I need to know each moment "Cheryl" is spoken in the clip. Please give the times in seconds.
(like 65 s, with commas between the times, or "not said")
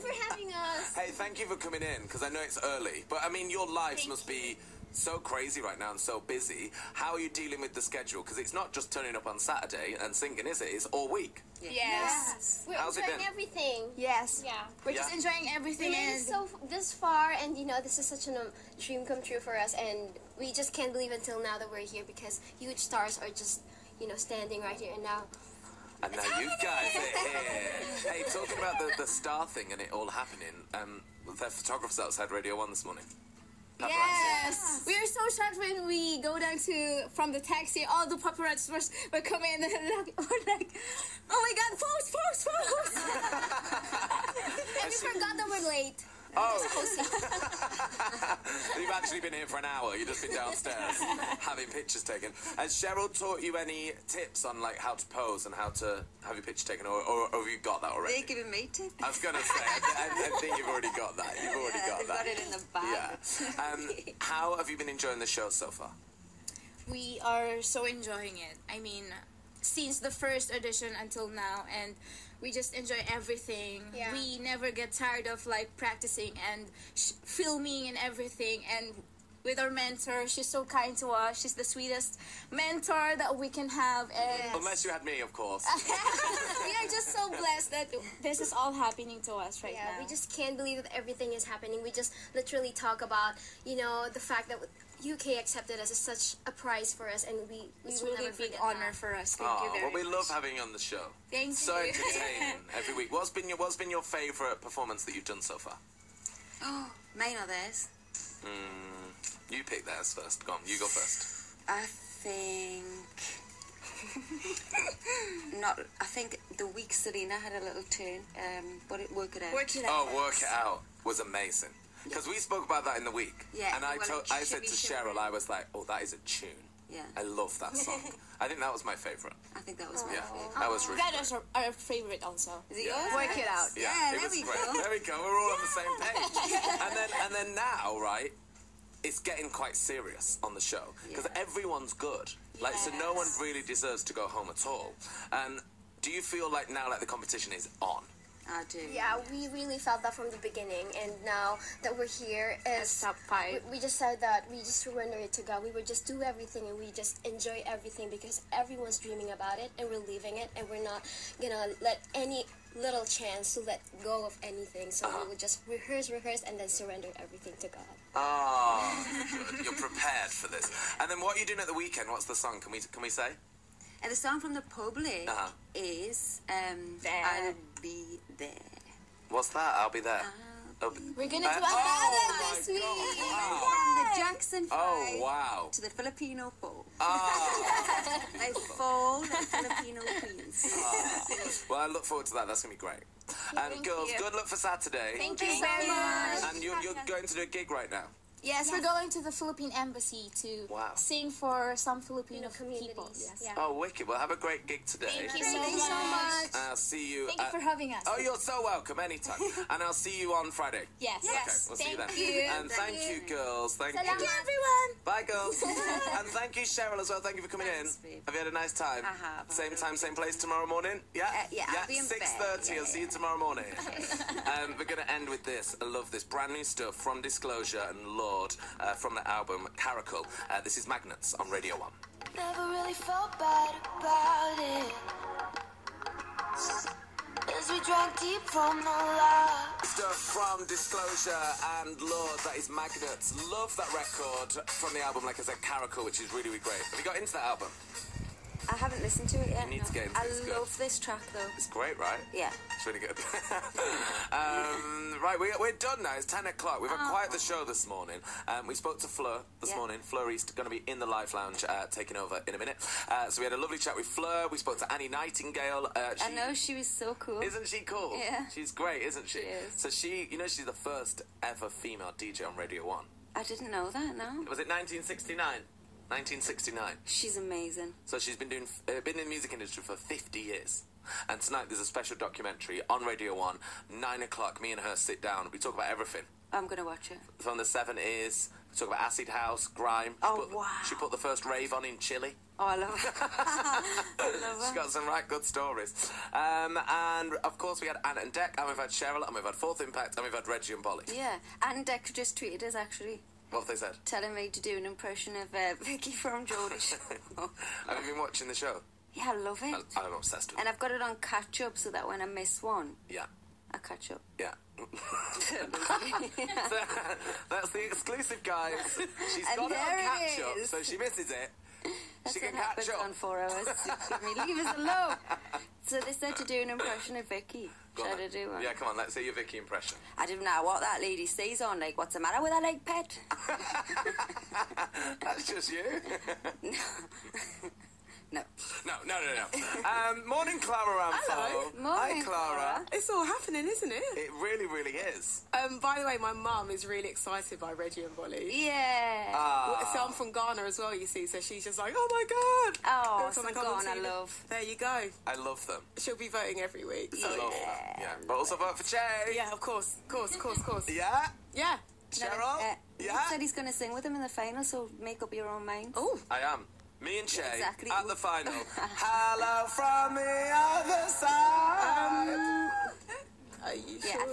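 52 s, 124 s, 216 s, 298 s, 362 s.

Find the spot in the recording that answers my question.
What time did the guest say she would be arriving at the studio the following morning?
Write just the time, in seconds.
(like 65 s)
222 s.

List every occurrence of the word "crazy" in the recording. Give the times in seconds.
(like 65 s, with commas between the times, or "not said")
5 s.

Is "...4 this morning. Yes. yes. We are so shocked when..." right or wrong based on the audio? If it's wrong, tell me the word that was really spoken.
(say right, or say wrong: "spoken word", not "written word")
wrong: "1", not "4".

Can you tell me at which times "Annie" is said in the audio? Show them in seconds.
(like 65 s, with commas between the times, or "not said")
264 s.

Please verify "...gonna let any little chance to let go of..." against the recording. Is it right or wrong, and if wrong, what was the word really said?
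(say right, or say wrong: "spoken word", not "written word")
right.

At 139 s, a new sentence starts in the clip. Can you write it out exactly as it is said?
It's getting quite serious on the show because everyone's good.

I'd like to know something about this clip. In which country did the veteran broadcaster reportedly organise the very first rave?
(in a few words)
Chile.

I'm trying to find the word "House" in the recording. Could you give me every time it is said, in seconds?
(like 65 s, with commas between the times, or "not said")
289 s.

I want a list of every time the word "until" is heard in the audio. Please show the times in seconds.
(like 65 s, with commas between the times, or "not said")
21 s, 71 s.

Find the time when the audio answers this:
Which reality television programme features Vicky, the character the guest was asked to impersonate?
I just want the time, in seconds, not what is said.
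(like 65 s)
306 s.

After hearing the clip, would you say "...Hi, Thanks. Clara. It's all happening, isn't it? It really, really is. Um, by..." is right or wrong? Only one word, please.
wrong.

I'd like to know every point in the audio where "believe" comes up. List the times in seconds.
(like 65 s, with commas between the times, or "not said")
20 s, 90 s.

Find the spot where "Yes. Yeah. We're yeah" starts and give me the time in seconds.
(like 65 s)
13 s.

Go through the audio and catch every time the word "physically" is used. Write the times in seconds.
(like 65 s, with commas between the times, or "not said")
not said.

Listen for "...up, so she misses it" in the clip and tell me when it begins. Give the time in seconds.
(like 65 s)
320 s.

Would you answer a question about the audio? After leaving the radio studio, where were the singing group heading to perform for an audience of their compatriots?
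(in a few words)
Philippine embassy.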